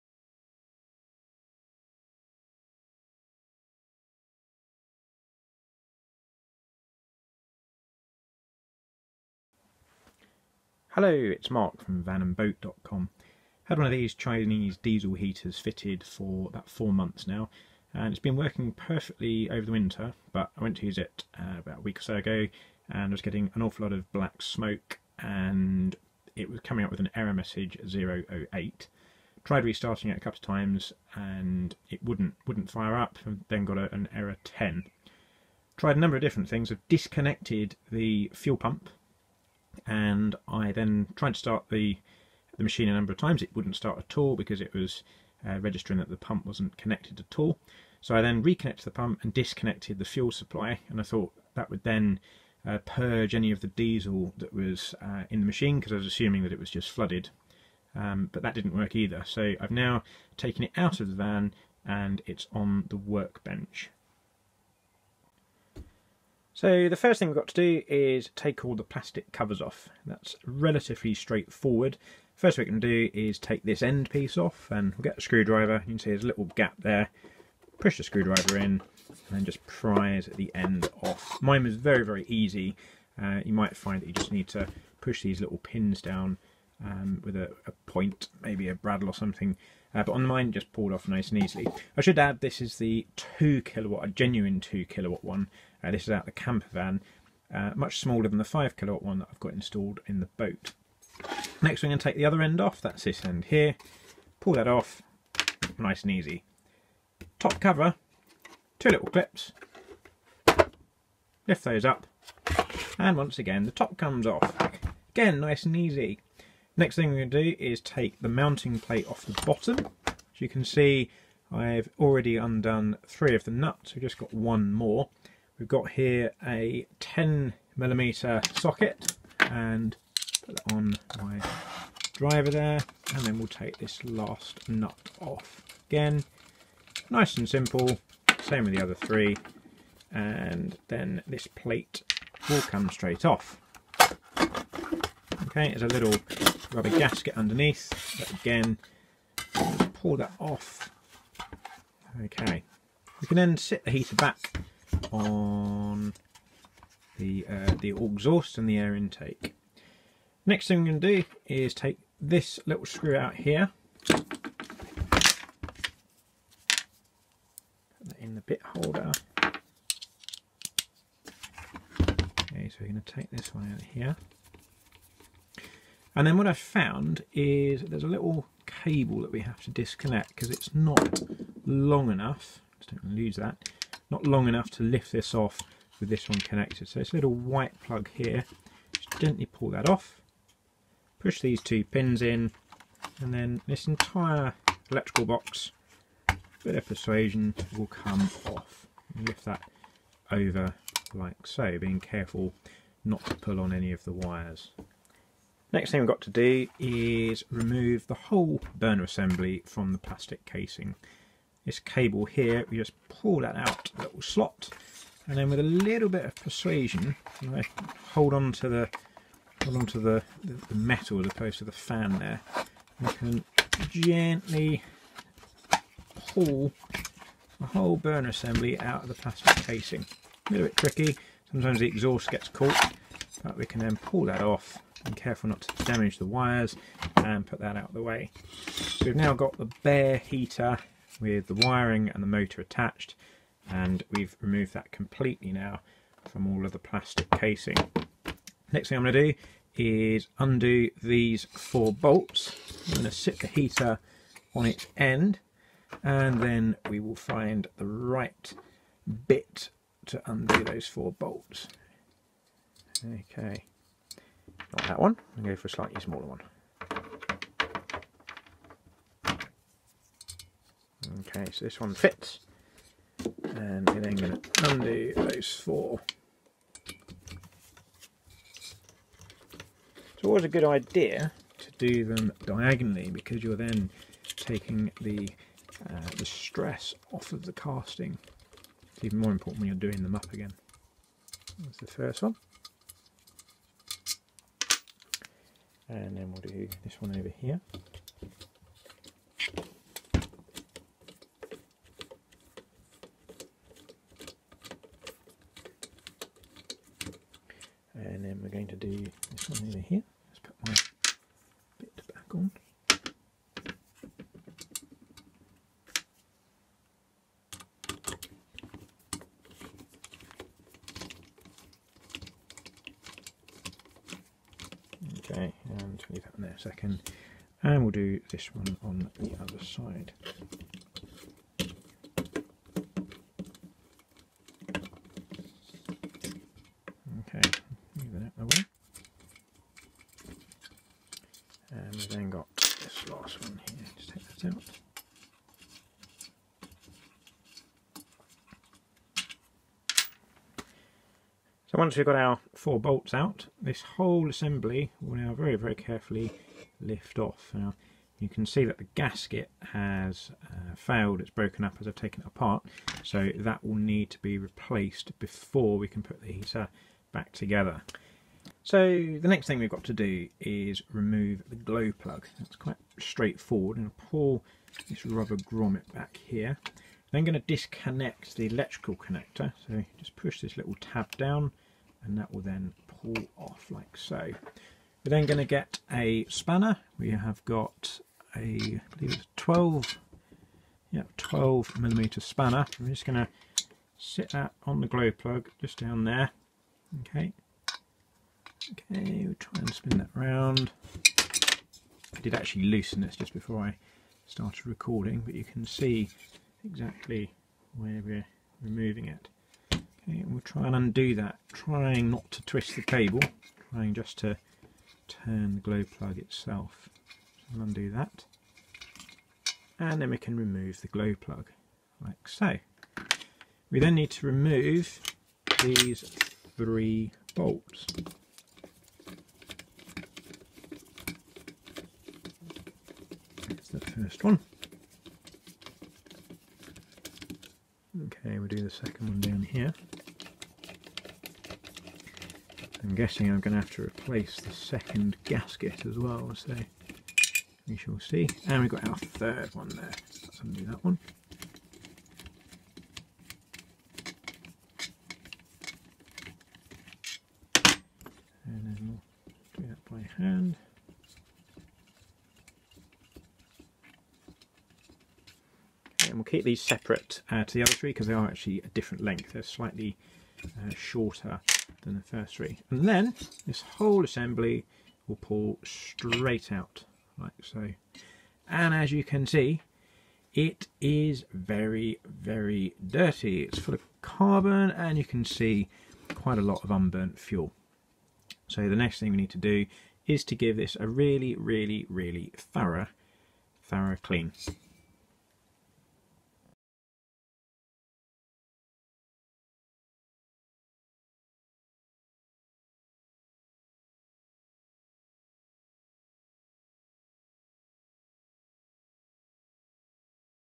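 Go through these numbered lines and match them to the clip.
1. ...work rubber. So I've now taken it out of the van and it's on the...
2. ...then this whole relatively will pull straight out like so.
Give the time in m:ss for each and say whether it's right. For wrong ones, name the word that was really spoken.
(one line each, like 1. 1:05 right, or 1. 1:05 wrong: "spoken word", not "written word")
1. 0:58 wrong: "either", not "rubber"
2. 7:52 wrong: "assembly", not "relatively".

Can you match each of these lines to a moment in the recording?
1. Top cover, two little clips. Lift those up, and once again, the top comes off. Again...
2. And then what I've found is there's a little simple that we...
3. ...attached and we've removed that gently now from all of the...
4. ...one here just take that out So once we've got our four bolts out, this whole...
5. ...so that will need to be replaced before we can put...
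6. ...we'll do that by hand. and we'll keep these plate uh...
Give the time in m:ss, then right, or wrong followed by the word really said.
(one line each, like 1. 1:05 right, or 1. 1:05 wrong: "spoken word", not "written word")
1. 1:47 right
2. 2:56 wrong: "cable", not "simple"
3. 4:02 wrong: "completely", not "gently"
4. 5:43 right
5. 6:03 right
6. 7:38 wrong: "separate", not "plate".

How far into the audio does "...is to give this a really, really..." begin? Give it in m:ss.
8:10.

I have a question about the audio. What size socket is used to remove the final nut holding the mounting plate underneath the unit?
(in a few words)
10 millimeter.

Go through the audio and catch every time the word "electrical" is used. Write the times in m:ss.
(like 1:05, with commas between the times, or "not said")
3:14, 6:18.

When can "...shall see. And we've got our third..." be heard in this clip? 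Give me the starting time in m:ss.
7:27.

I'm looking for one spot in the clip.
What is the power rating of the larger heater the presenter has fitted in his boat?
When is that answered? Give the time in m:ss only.
1:38.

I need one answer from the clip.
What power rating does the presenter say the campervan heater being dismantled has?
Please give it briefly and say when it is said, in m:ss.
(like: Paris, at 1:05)
2 kilowatt, at 1:34.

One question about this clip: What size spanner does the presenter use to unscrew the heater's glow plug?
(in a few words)
12 millimeter.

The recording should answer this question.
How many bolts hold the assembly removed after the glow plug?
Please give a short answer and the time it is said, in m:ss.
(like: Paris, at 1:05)
3, at 7:06.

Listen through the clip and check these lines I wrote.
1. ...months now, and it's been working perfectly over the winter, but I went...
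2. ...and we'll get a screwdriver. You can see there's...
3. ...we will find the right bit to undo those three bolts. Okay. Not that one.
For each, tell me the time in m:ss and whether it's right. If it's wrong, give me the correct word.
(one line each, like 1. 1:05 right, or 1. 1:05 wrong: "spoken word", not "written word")
1. 0:16 right
2. 1:14 right
3. 4:16 wrong: "four", not "three".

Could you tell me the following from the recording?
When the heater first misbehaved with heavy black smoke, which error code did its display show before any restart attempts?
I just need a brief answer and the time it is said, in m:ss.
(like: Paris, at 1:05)
008, at 0:27.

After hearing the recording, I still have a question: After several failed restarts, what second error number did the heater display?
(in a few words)
10.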